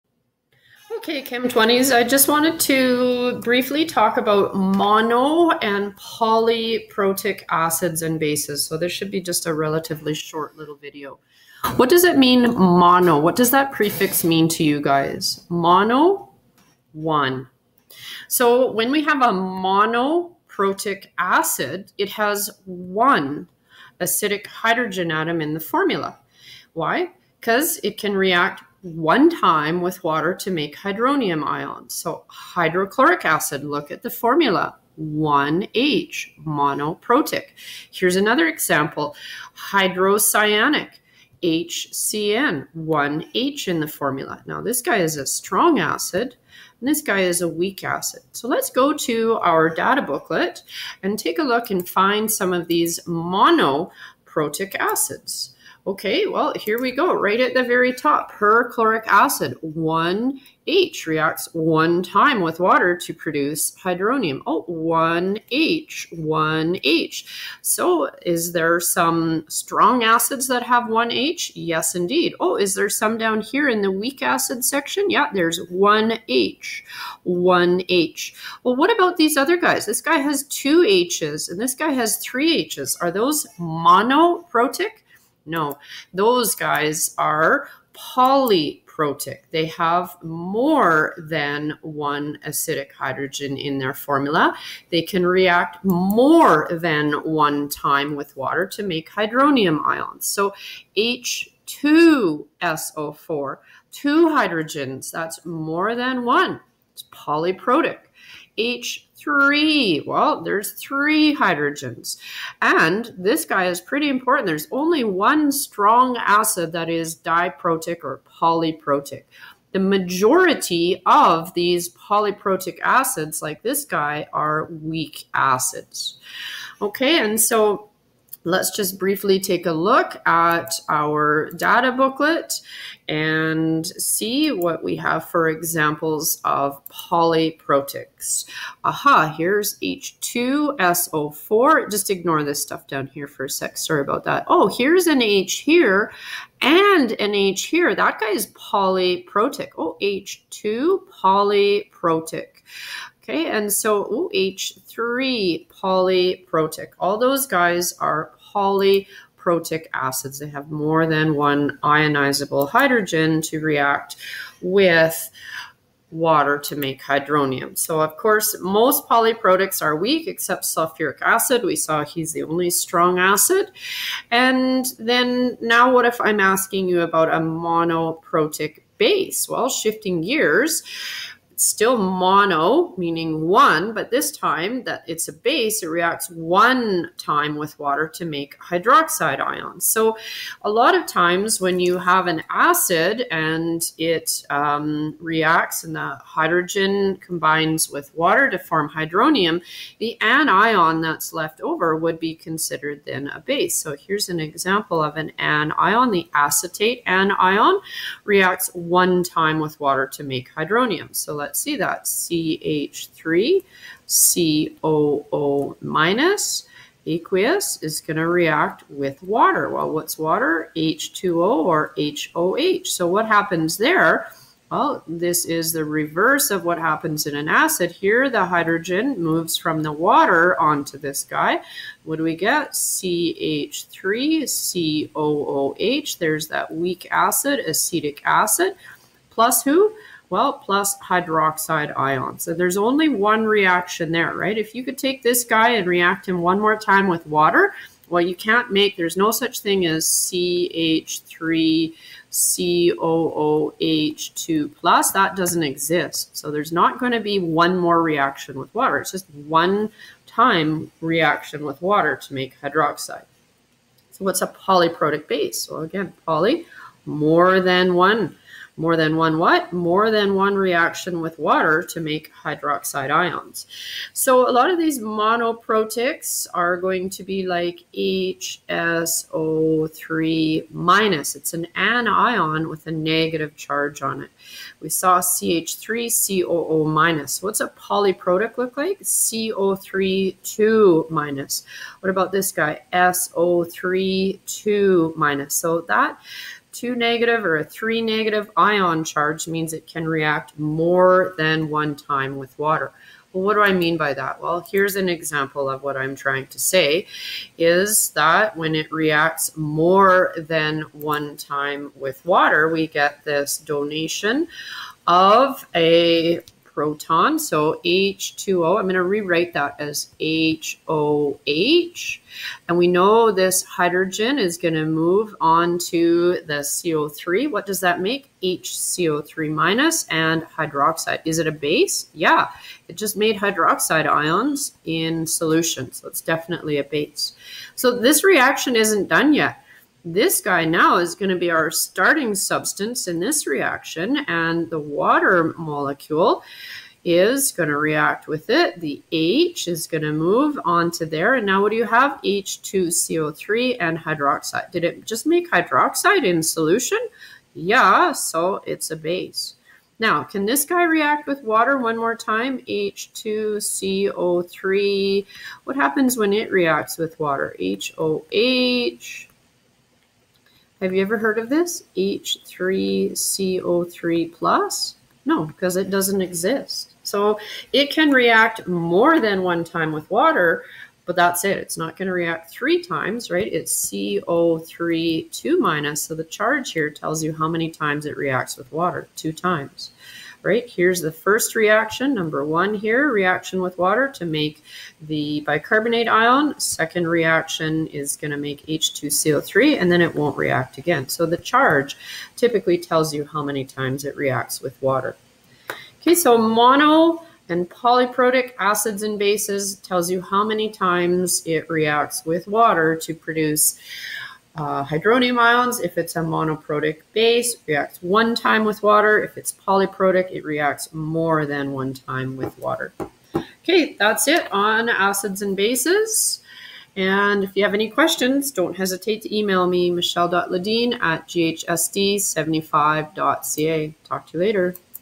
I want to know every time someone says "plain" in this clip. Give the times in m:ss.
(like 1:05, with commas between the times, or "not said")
not said.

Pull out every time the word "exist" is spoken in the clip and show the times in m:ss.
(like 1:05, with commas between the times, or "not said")
4:15, 6:16.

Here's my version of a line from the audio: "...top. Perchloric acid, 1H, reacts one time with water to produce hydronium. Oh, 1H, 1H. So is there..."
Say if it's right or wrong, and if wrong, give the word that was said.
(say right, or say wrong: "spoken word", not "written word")
right.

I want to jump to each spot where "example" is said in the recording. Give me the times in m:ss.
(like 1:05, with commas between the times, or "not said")
0:38, 2:15, 3:24, 5:05.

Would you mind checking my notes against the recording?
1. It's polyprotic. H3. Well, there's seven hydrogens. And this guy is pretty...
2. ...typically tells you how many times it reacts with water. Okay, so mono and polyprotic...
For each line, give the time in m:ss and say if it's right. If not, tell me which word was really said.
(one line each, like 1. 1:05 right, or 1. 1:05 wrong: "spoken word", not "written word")
1. 1:46 wrong: "three", not "seven"
2. 6:42 right.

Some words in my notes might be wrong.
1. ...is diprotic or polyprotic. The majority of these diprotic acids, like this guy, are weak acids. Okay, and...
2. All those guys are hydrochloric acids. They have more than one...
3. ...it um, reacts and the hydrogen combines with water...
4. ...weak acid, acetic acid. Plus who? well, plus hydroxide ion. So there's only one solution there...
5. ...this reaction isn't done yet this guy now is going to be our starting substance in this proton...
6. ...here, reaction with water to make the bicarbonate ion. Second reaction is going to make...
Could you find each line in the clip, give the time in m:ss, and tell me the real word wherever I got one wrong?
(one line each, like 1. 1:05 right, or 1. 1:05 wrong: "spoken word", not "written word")
1. 1:56 wrong: "polyprotic", not "diprotic"
2. 2:36 wrong: "polyprotic", not "hydrochloric"
3. 3:13 right
4. 3:56 wrong: "reaction", not "solution"
5. 5:37 wrong: "reaction", not "proton"
6. 6:32 right.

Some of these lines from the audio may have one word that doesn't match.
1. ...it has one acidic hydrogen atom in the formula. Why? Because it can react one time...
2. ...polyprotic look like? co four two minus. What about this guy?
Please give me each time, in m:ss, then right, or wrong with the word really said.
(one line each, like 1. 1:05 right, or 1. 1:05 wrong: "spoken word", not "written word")
1. 0:21 right
2. 4:47 wrong: "three", not "four".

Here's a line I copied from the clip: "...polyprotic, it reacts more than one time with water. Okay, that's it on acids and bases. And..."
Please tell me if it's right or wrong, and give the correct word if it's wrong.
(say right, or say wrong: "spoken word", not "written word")
right.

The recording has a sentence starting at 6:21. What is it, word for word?
It's not going to react three times, right?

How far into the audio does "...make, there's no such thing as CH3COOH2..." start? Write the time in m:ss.
4:08.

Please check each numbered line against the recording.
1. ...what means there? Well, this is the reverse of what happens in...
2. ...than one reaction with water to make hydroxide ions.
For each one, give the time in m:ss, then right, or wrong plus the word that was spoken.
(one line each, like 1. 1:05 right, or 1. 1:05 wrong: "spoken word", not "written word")
1. 3:43 wrong: "happens", not "means"
2. 4:30 right.